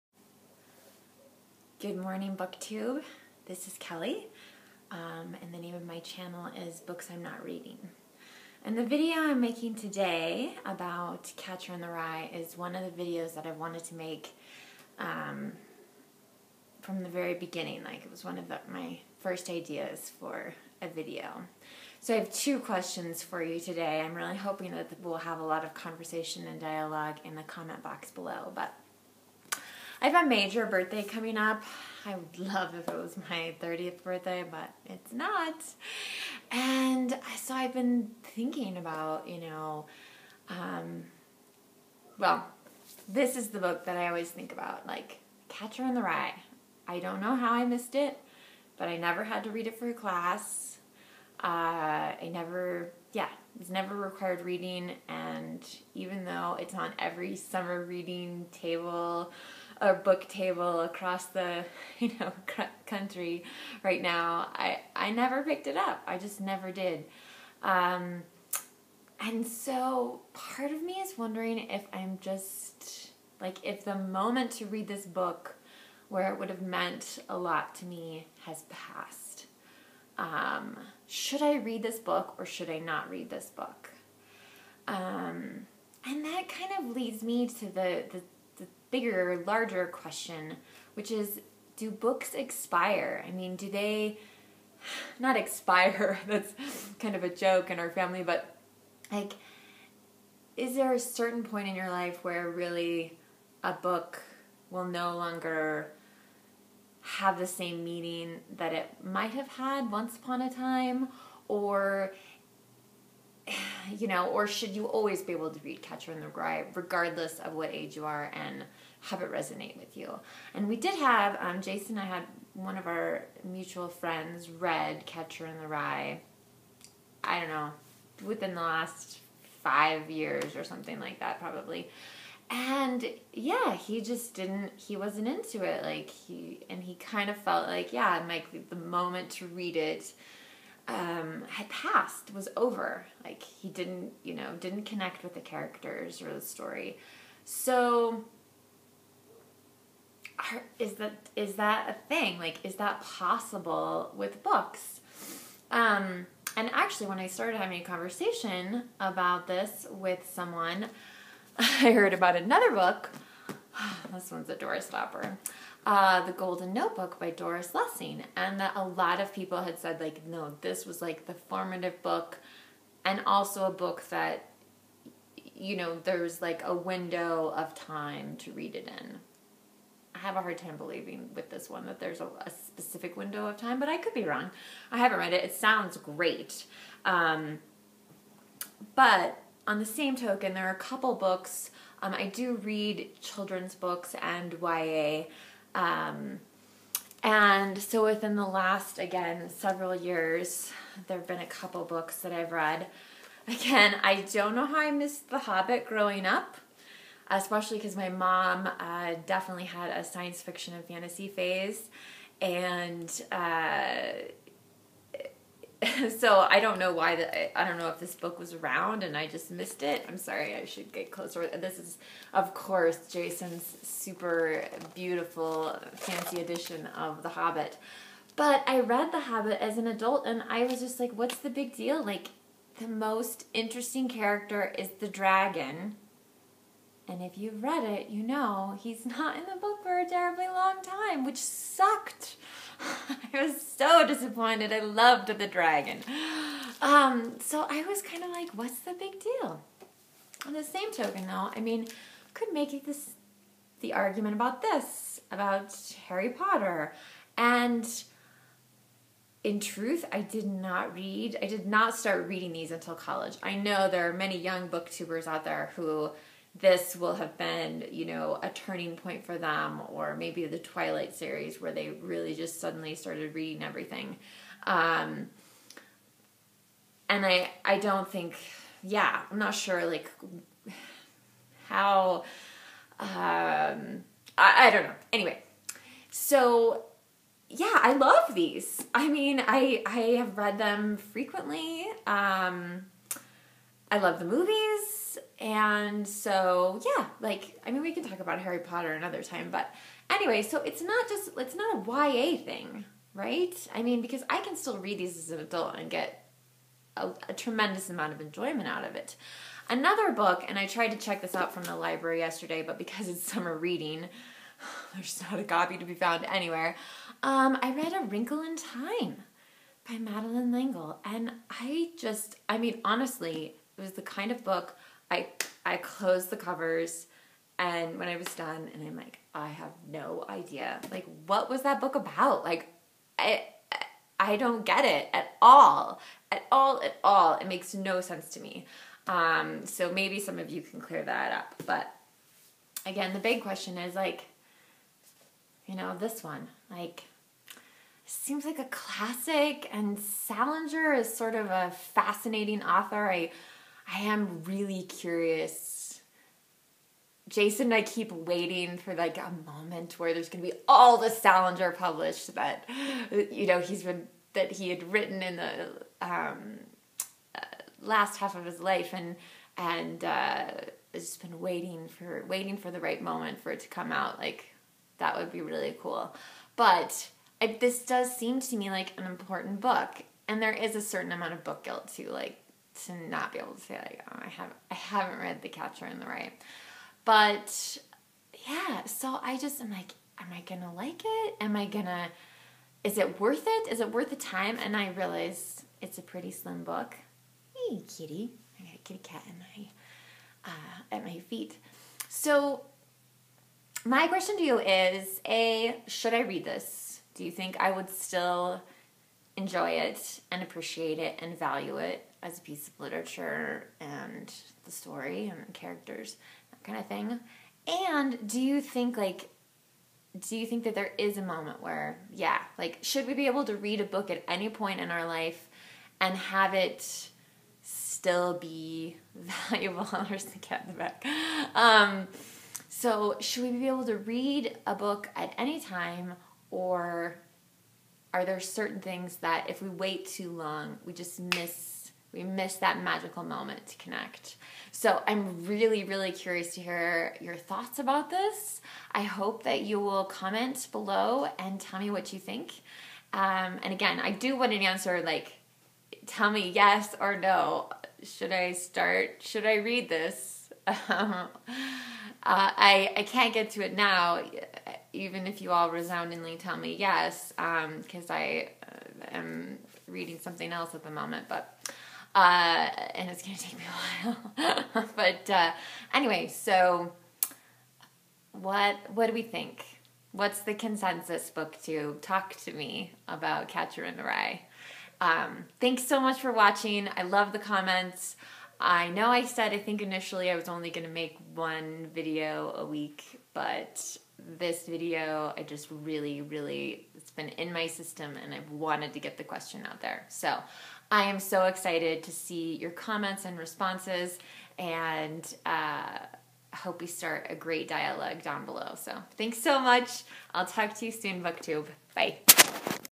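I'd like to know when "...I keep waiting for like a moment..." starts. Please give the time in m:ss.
5:57.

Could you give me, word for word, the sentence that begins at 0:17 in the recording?
Like, it was one of the, my first ideas for a video.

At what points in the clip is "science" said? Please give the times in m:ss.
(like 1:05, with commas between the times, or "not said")
3:30.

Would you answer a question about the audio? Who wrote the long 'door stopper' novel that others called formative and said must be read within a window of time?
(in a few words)
Doris Lessing.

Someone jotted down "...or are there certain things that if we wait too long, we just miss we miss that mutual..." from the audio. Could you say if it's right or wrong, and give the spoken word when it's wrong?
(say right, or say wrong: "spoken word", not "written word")
wrong: "magical", not "mutual".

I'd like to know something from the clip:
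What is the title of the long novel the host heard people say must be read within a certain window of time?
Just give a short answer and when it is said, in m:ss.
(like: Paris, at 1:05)
The Golden Notebook, at 2:46.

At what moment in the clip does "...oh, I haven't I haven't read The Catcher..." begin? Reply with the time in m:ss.
6:24.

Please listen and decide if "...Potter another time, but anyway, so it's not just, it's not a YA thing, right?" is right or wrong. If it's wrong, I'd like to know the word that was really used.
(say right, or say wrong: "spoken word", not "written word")
right.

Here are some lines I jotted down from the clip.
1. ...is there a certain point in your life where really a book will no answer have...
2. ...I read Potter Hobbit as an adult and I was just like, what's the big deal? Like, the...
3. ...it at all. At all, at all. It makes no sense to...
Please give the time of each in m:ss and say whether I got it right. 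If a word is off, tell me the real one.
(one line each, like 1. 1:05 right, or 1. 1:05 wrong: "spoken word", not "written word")
1. 1:40 wrong: "longer", not "answer"
2. 3:48 wrong: "The", not "Potter"
3. 5:34 right.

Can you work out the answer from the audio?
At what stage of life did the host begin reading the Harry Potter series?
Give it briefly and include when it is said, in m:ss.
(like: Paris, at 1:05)
college, at 4:22.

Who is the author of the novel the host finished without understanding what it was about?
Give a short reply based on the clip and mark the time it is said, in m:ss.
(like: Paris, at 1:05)
Madeleine L'Engle, at 5:19.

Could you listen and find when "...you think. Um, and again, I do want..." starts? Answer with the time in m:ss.
7:32.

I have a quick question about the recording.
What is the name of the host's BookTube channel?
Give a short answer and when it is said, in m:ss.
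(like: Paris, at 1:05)
Books I'm Not Reading, at 0:06.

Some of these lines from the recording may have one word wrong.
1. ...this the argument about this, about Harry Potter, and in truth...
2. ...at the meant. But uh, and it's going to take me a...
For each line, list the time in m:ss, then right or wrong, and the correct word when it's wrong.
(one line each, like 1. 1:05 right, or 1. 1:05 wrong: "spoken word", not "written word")
1. 4:12 right
2. 7:50 wrong: "moment", not "meant".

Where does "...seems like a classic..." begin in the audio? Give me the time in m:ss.
5:48.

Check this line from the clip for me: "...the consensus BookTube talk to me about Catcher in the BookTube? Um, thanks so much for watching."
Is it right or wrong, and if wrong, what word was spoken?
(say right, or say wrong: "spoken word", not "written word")
wrong: "Rye", not "BookTube".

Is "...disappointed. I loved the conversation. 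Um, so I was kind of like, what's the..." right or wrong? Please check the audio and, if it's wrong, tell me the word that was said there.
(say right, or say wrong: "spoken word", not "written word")
wrong: "dragon", not "conversation".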